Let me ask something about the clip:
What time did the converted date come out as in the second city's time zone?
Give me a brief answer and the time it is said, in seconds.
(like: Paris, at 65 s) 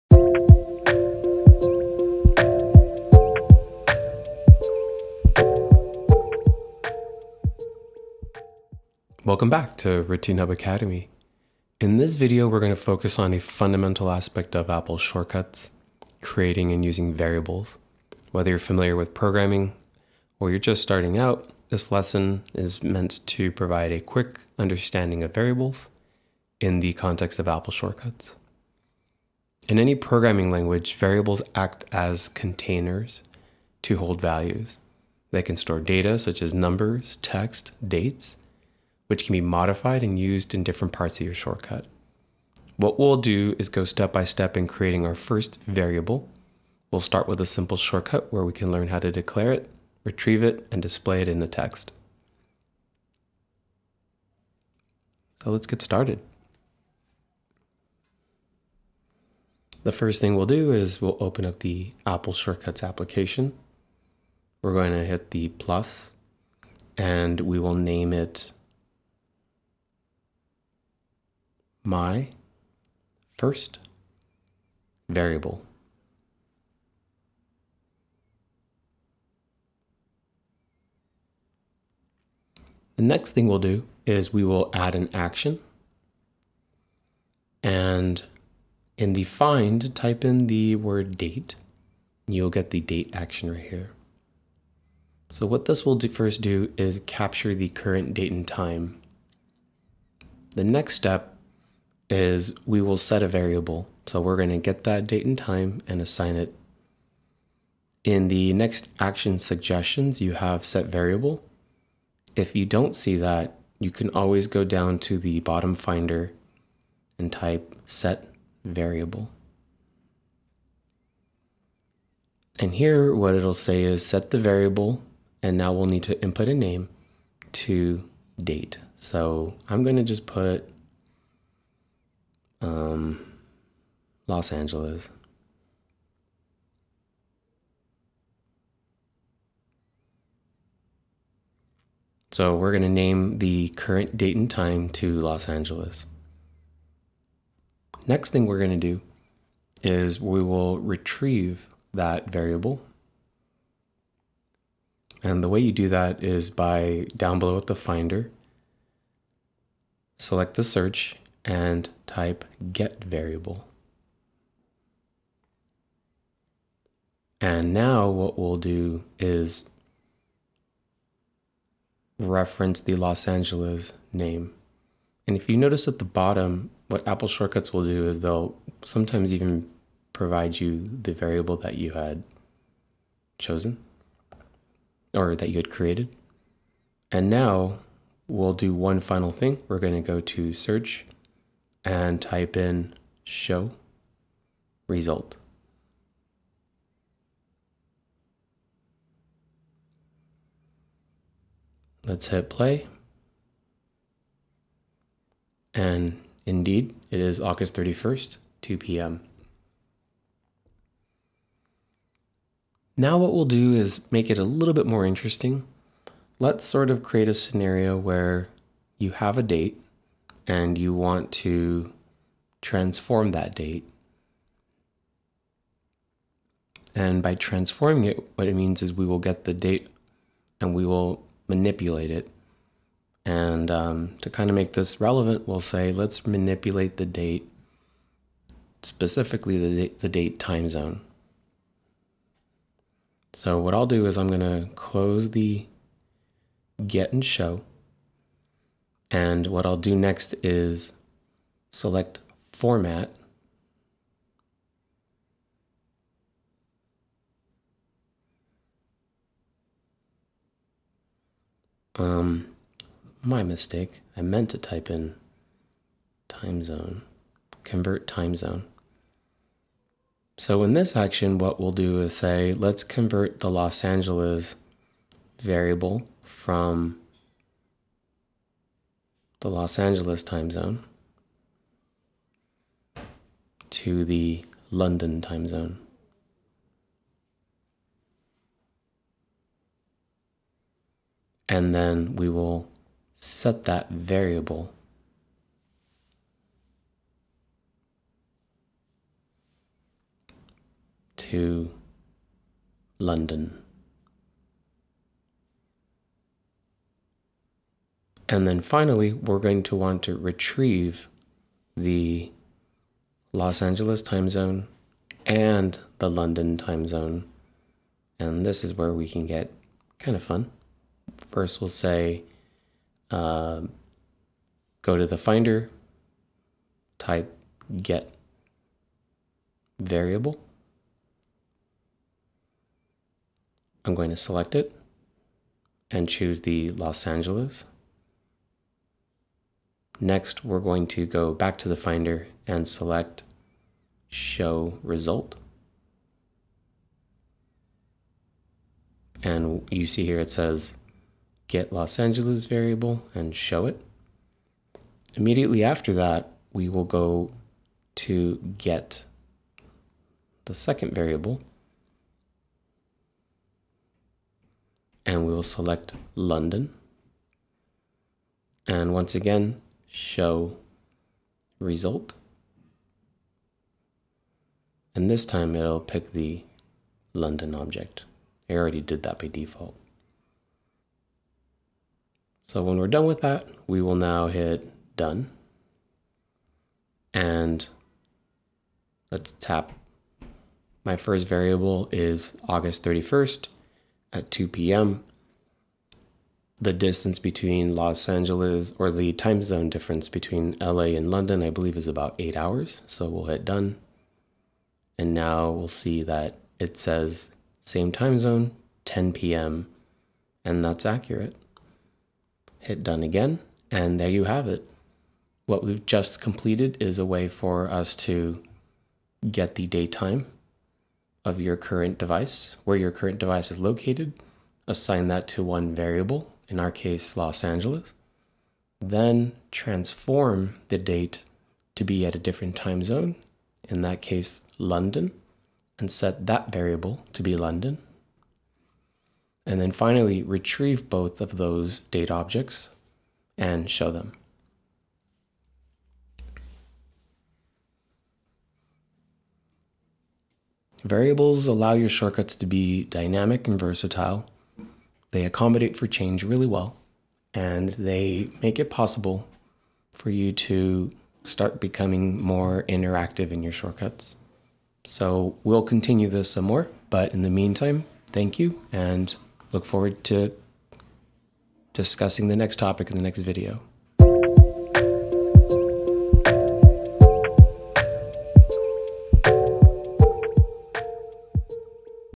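10 p.m., at 408 s.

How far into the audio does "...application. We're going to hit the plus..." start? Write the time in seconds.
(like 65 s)
62 s.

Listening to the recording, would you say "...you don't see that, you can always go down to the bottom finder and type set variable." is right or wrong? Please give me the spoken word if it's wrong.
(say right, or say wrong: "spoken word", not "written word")
right.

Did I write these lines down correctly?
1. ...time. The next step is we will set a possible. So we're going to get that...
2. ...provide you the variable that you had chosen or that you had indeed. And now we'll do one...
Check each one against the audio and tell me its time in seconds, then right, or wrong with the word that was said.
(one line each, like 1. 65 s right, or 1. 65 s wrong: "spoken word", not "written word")
1. 98 s wrong: "variable", not "possible"
2. 180 s wrong: "created", not "indeed".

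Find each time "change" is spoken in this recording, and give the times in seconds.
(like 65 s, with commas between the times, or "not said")
455 s.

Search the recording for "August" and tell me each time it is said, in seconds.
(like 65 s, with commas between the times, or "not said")
207 s, 392 s.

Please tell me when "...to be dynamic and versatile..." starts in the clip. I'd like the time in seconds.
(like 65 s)
452 s.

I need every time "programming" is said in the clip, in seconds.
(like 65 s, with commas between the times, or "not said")
19 s, 29 s.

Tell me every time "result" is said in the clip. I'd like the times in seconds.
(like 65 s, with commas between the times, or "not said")
194 s, 344 s, 371 s.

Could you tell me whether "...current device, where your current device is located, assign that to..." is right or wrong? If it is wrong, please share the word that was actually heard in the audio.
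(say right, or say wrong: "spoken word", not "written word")
right.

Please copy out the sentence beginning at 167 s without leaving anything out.
And now what we'll do is reference the Los Angeles name.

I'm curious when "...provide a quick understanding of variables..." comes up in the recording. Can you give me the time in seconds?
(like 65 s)
23 s.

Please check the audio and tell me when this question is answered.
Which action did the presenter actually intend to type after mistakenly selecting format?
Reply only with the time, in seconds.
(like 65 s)
267 s.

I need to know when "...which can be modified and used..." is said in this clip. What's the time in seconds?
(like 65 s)
39 s.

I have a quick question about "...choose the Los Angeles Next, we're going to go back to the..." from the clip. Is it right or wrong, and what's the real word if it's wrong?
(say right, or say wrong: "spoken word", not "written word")
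right.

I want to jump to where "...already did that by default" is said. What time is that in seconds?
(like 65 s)
378 s.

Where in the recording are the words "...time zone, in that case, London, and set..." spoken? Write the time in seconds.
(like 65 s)
432 s.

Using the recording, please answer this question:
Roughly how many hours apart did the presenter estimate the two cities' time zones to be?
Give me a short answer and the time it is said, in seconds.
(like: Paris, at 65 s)
8 hours, at 402 s.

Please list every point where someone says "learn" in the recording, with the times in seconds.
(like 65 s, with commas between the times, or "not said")
48 s.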